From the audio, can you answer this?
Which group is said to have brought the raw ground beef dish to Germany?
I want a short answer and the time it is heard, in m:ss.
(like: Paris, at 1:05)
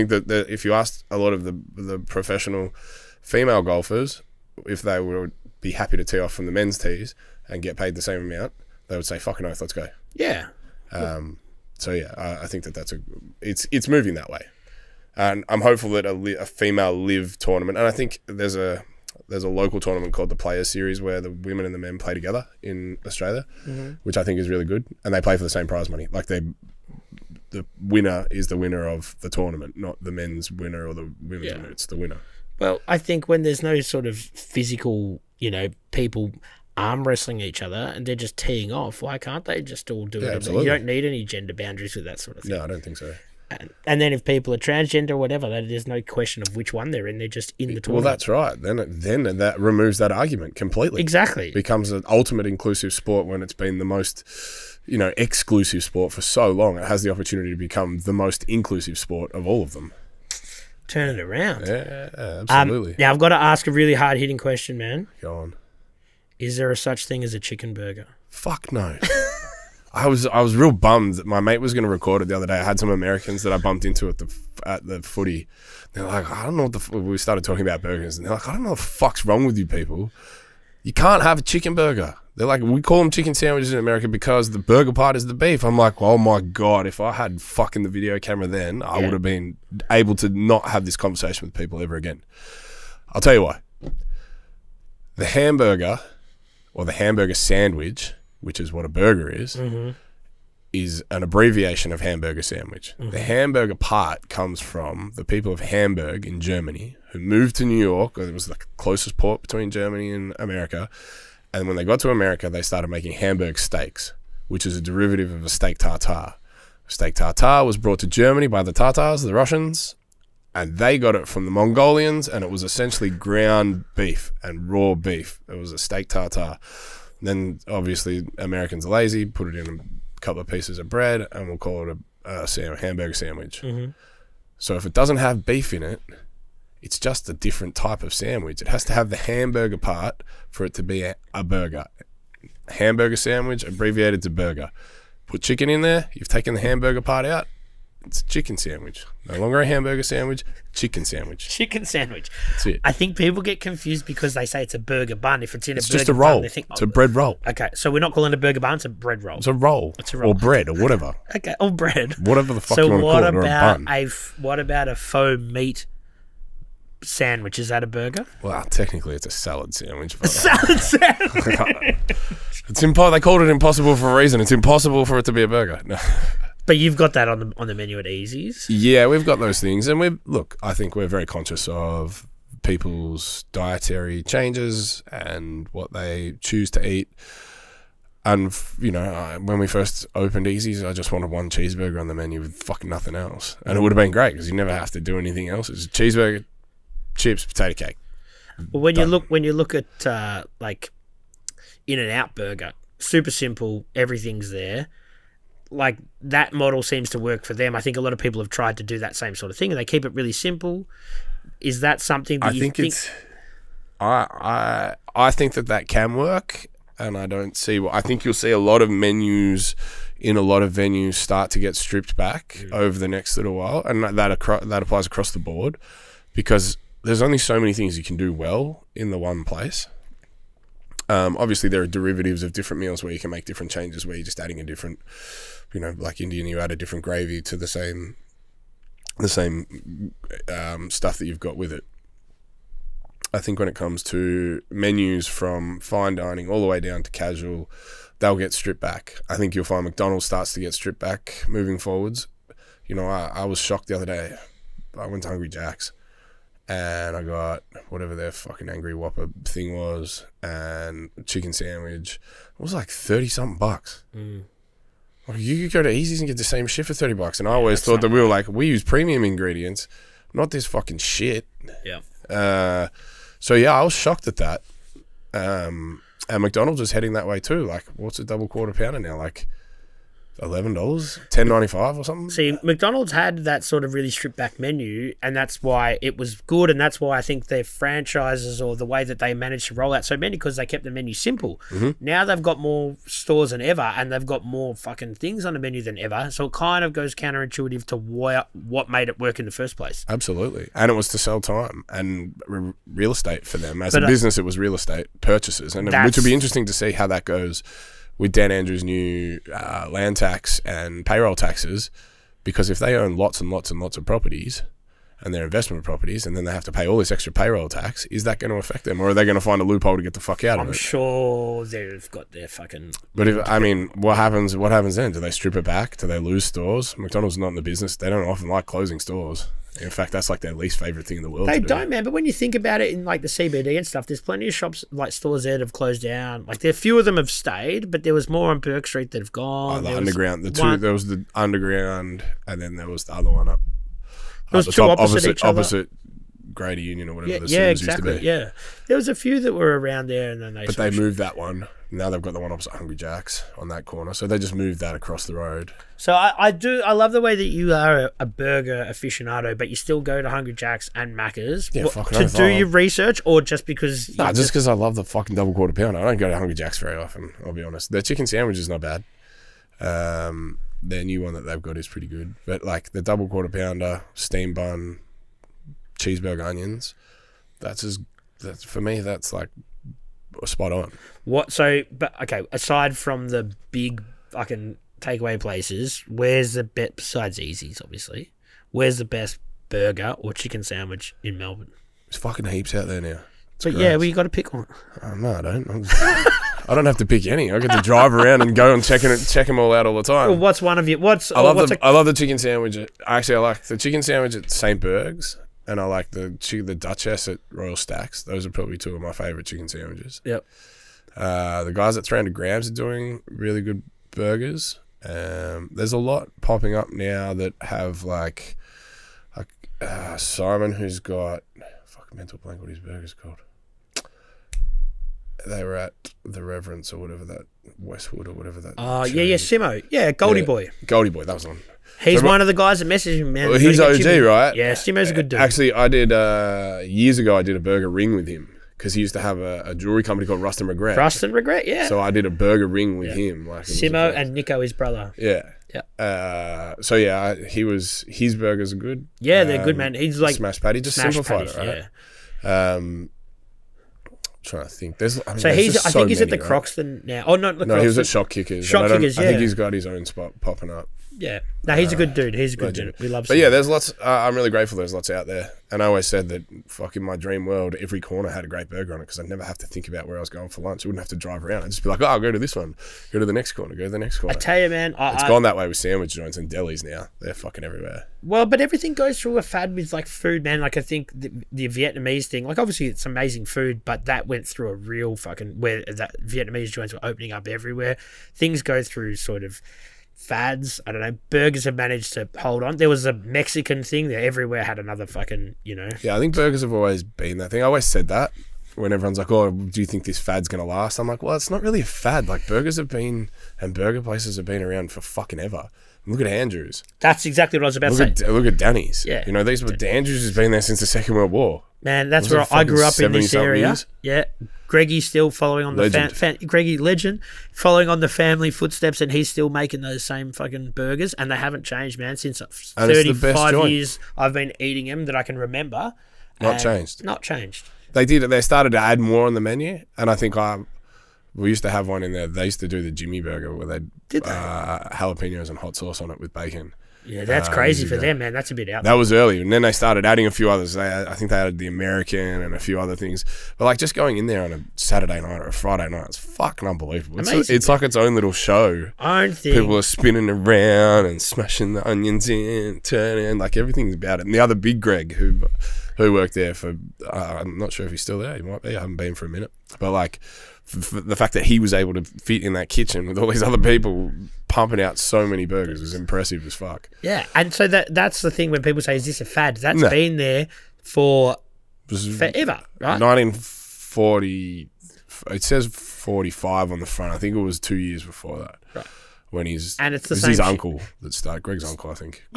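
The Tartars, at 1:58.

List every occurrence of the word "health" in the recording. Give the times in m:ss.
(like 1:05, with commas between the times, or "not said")
not said.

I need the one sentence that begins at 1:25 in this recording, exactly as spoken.
I'm like, oh my god, if I had fucking the video camera then, I yeah.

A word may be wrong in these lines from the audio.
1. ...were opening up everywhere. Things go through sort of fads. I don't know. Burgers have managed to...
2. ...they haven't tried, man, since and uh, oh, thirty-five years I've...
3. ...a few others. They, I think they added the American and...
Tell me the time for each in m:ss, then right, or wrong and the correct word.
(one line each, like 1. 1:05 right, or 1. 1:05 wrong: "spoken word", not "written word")
1. 8:06 right
2. 8:41 wrong: "changed", not "tried"
3. 9:00 right.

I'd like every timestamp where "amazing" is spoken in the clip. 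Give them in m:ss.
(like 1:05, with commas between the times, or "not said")
8:03, 9:07.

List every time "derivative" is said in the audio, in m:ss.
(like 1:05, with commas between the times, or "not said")
1:54, 3:51.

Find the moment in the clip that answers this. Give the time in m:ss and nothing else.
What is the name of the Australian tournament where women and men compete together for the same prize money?
0:20.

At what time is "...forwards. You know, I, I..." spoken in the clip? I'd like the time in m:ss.
4:11.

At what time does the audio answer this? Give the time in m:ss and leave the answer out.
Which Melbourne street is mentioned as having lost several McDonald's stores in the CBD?
5:38.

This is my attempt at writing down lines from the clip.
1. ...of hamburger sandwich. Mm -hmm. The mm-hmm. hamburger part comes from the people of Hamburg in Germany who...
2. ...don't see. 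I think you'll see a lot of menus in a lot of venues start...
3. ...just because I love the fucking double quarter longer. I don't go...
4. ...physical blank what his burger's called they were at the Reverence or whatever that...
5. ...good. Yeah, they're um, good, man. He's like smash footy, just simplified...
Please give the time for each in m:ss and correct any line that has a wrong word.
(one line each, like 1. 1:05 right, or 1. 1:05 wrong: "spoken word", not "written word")
1. 1:41 right
2. 3:37 right
3. 6:04 wrong: "pounder", not "longer"
4. 7:02 wrong: "mental", not "physical"
5. 7:28 wrong: "patty", not "footy".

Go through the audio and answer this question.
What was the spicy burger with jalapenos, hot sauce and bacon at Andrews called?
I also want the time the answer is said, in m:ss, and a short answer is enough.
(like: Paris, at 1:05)
Jimmy Burger, at 8:52.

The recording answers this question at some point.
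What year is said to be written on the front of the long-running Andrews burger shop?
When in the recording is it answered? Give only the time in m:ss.
9:35.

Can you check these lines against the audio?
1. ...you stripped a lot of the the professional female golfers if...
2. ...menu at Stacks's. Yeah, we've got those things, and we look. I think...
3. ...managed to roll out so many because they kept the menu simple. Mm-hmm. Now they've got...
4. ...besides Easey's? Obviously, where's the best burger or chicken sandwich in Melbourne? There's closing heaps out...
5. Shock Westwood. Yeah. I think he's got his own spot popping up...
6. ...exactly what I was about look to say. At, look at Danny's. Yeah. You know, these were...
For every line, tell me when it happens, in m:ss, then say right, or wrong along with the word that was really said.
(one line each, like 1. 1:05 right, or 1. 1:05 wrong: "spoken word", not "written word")
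1. 0:00 wrong: "asked", not "stripped"
2. 2:57 wrong: "Easey", not "Stacks"
3. 4:49 right
4. 6:26 wrong: "fucking", not "closing"
5. 7:38 wrong: "Kickers", not "Westwood"
6. 8:27 right.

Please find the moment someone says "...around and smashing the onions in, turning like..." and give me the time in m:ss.
9:10.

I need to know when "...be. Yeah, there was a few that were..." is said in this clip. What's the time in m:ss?
5:48.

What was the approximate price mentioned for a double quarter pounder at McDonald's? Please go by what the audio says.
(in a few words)
$10.95.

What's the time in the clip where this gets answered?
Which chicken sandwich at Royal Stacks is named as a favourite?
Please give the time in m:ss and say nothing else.
6:46.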